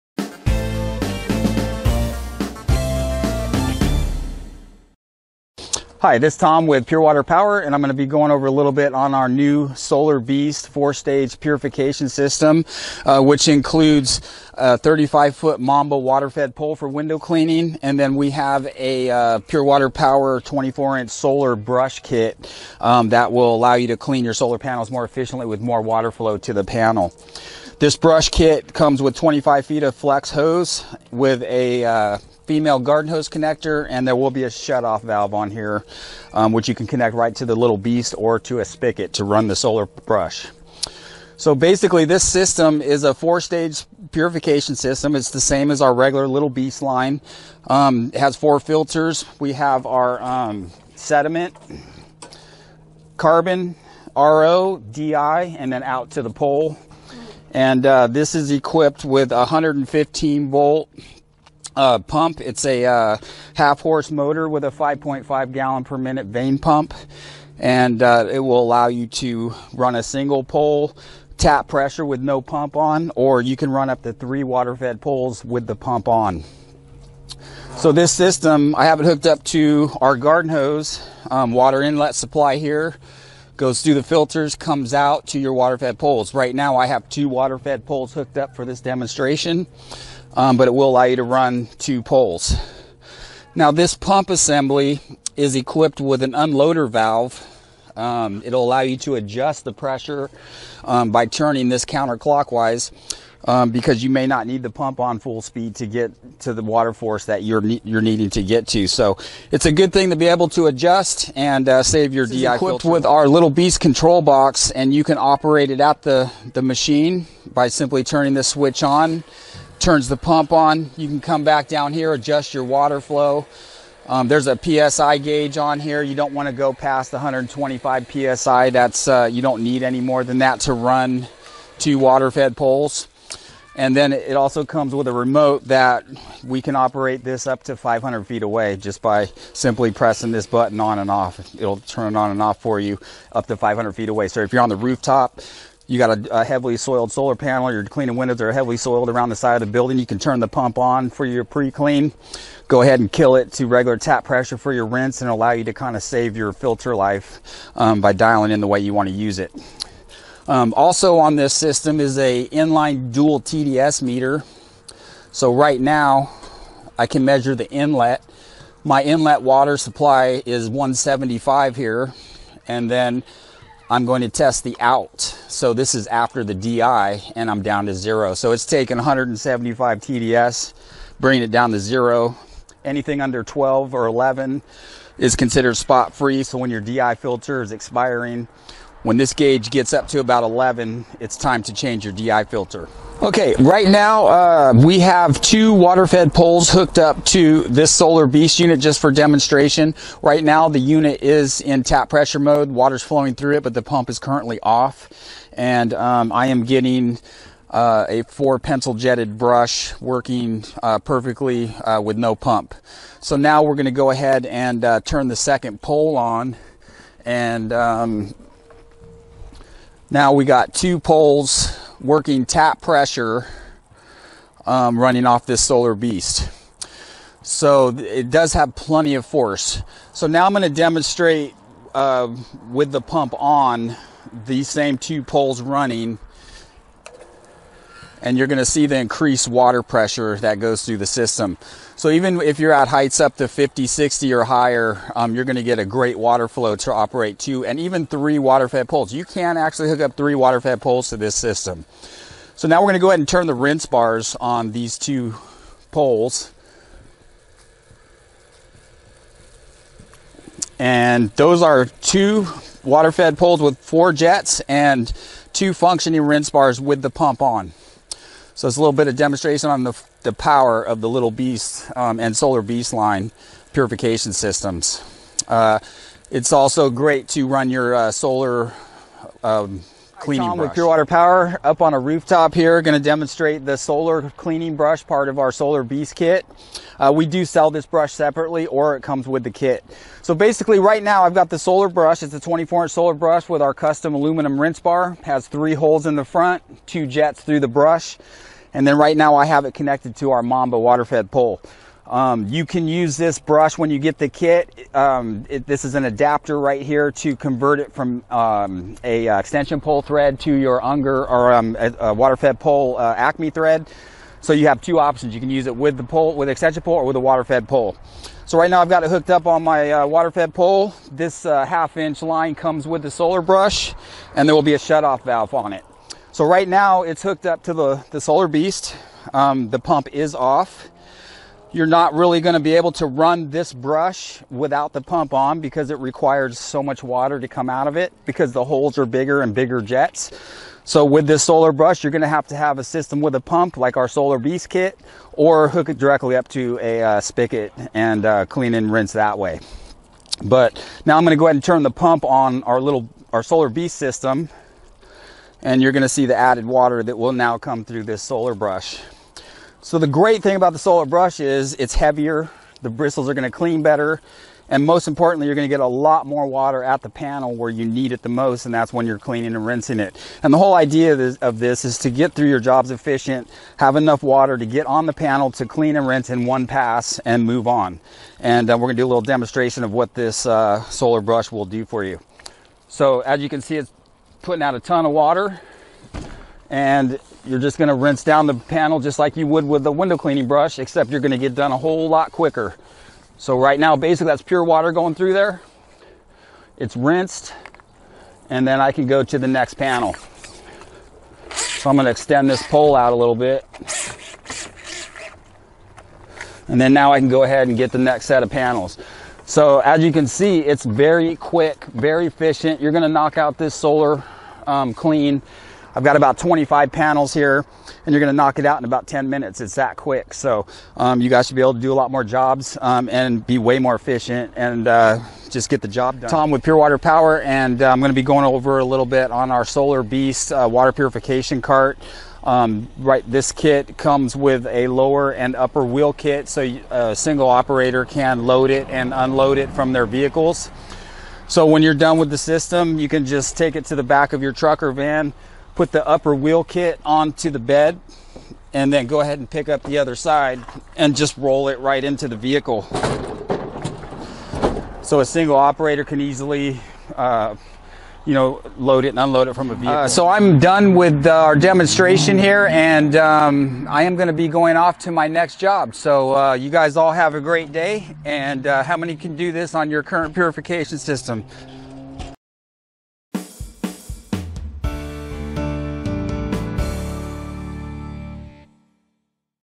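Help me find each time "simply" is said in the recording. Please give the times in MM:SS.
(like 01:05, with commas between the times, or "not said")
01:57, 02:19.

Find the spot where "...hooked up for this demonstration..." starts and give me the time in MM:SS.
01:28.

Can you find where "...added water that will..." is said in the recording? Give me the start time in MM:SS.
05:56.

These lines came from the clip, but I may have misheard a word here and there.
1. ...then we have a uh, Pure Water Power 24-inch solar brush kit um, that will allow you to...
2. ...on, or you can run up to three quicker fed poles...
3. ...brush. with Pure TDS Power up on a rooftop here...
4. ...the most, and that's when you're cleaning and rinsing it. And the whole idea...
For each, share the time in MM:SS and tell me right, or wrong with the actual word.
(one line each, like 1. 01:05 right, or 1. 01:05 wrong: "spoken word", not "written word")
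1. 00:17 right
2. 01:12 wrong: "water", not "quicker"
3. 04:40 wrong: "Water", not "TDS"
4. 06:08 right.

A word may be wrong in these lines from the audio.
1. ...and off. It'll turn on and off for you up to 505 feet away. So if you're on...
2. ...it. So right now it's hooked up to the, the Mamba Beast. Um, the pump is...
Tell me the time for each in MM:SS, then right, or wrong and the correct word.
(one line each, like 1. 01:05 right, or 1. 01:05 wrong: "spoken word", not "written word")
1. 02:20 wrong: "500", not "505"
2. 05:25 wrong: "Solar", not "Mamba".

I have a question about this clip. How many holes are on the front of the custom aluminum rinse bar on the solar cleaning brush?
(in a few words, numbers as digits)
3.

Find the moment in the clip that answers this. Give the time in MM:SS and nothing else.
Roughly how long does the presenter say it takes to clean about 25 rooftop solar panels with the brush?
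06:59.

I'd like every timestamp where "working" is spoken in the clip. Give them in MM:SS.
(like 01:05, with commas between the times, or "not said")
03:29, 03:42.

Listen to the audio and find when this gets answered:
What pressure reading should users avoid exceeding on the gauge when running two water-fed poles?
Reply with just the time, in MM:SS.
02:07.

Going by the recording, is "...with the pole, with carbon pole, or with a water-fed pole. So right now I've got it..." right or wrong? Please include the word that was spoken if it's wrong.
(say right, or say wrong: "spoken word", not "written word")
wrong: "extension", not "carbon".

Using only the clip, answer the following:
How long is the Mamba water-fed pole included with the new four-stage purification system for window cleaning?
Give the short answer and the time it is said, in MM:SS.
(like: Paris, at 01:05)
35 feet, at 00:14.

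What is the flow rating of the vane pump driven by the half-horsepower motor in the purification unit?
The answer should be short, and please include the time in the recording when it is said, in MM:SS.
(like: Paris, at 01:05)
5.5 gallons per minute, at 01:04.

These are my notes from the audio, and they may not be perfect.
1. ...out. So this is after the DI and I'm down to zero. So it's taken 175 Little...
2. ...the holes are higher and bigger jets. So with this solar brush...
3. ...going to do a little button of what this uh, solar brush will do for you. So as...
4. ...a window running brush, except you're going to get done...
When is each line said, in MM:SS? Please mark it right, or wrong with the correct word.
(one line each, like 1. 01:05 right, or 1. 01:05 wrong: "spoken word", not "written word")
1. 02:54 wrong: "TDS", not "Little"
2. 05:38 wrong: "bigger", not "higher"
3. 06:18 wrong: "demonstration", not "button"
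4. 06:29 wrong: "cleaning", not "running".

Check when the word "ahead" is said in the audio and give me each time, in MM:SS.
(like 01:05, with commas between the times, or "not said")
02:32, 03:34, 04:13, 05:51, 06:47, 07:29.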